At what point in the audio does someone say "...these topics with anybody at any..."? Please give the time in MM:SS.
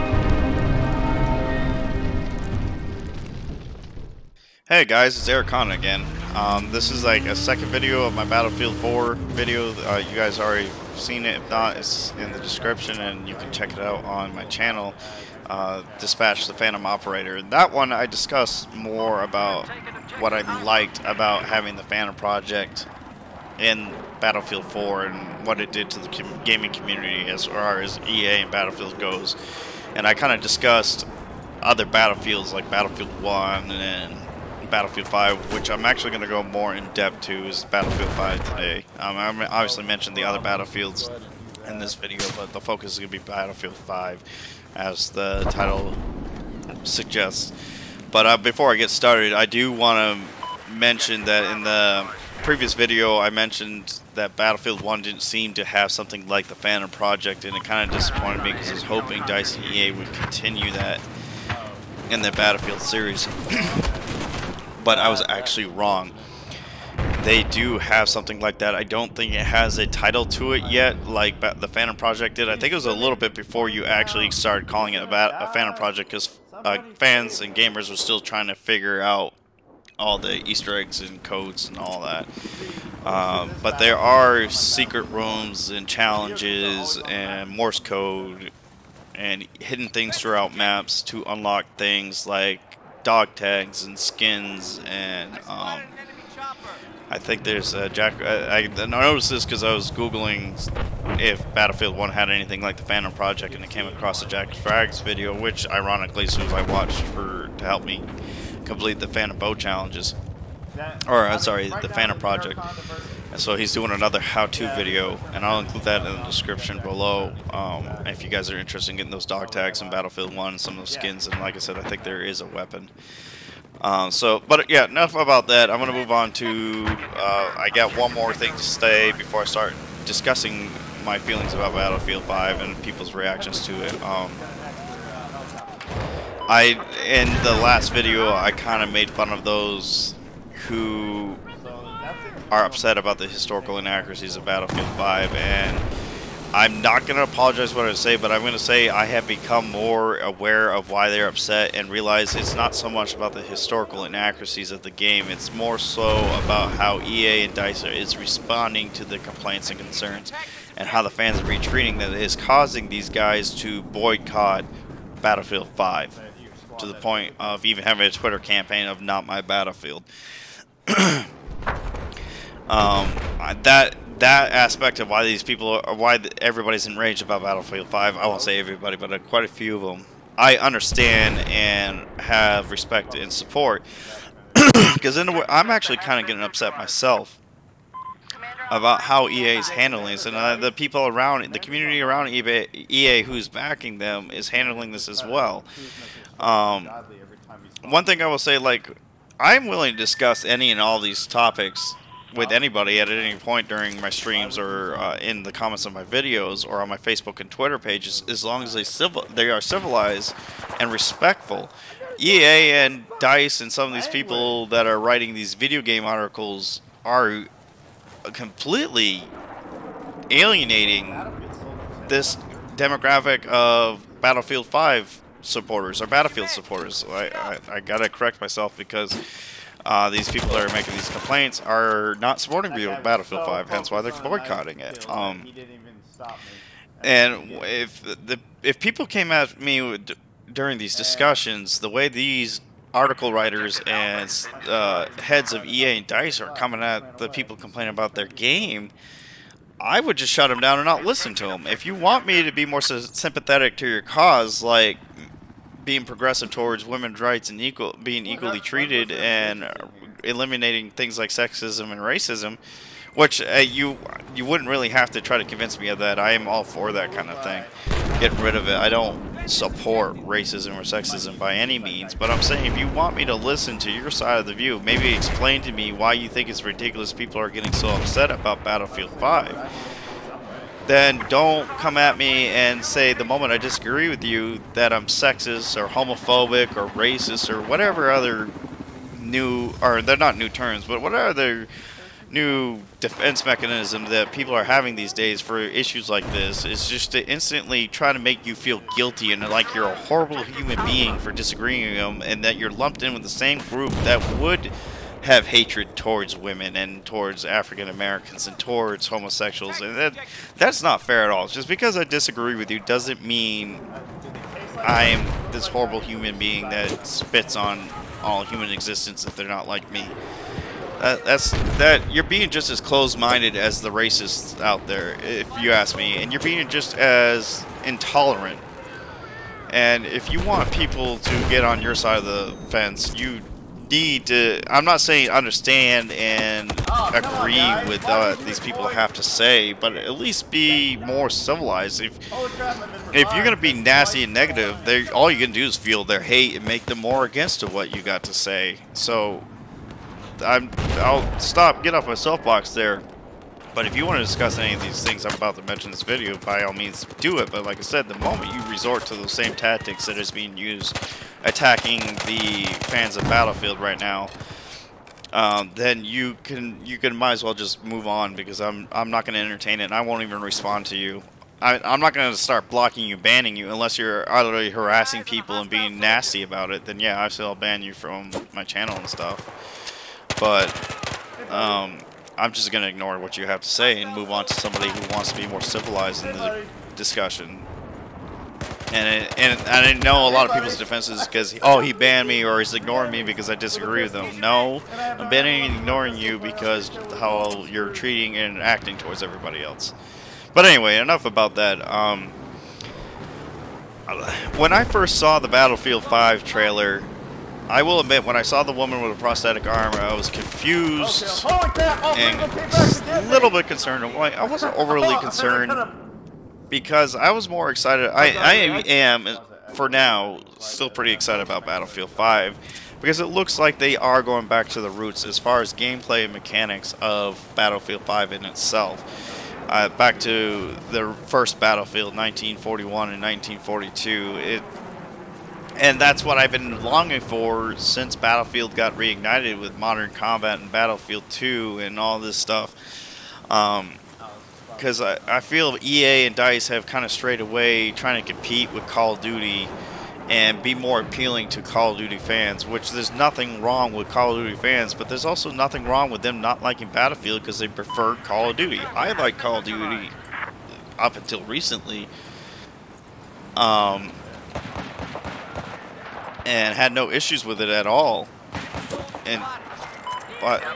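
03:20.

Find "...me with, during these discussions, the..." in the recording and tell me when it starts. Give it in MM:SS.
03:59.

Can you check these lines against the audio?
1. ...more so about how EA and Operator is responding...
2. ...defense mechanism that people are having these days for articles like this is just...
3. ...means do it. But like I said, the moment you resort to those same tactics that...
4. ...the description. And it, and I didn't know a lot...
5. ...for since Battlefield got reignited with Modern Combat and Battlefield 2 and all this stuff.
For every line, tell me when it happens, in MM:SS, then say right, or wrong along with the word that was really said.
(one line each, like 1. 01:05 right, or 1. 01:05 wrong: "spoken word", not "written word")
1. 02:35 wrong: "DICE", not "Operator"
2. 04:53 wrong: "issues", not "articles"
3. 05:56 right
4. 06:26 wrong: "discussion", not "description"
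5. 07:17 right.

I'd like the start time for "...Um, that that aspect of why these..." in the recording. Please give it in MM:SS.
02:52.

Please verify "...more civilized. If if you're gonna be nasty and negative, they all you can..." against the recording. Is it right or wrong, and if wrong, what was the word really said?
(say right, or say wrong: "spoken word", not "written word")
right.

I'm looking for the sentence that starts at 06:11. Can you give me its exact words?
I, I'm not going to start blocking you, banning you, unless you're utterly harassing people and being nasty about it.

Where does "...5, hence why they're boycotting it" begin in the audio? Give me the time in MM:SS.
03:53.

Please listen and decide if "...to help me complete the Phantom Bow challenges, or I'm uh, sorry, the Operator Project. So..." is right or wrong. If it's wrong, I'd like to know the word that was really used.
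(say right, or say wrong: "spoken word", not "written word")
wrong: "Phantom", not "Operator".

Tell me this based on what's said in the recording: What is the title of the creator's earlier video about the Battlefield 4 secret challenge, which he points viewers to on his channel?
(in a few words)
Dispatch the Phantom Operator.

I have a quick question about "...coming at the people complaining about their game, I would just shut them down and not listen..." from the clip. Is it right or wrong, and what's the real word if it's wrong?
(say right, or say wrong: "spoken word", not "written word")
right.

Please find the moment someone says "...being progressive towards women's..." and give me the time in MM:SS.
04:15.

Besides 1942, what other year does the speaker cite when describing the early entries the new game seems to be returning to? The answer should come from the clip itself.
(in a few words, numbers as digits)
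1941.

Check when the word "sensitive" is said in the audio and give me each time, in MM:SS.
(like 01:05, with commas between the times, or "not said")
not said.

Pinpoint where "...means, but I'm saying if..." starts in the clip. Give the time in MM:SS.
04:31.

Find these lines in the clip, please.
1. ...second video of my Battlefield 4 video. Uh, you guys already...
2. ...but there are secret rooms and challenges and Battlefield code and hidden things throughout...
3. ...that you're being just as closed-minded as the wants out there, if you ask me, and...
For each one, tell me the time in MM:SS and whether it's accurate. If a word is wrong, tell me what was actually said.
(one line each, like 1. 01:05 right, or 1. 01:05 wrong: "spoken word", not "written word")
1. 00:07 right
2. 01:23 wrong: "Morse", not "Battlefield"
3. 05:21 wrong: "racists", not "wants".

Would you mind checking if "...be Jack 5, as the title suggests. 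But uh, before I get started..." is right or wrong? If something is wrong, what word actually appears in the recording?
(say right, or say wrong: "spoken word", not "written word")
wrong: "Battlefield", not "Jack".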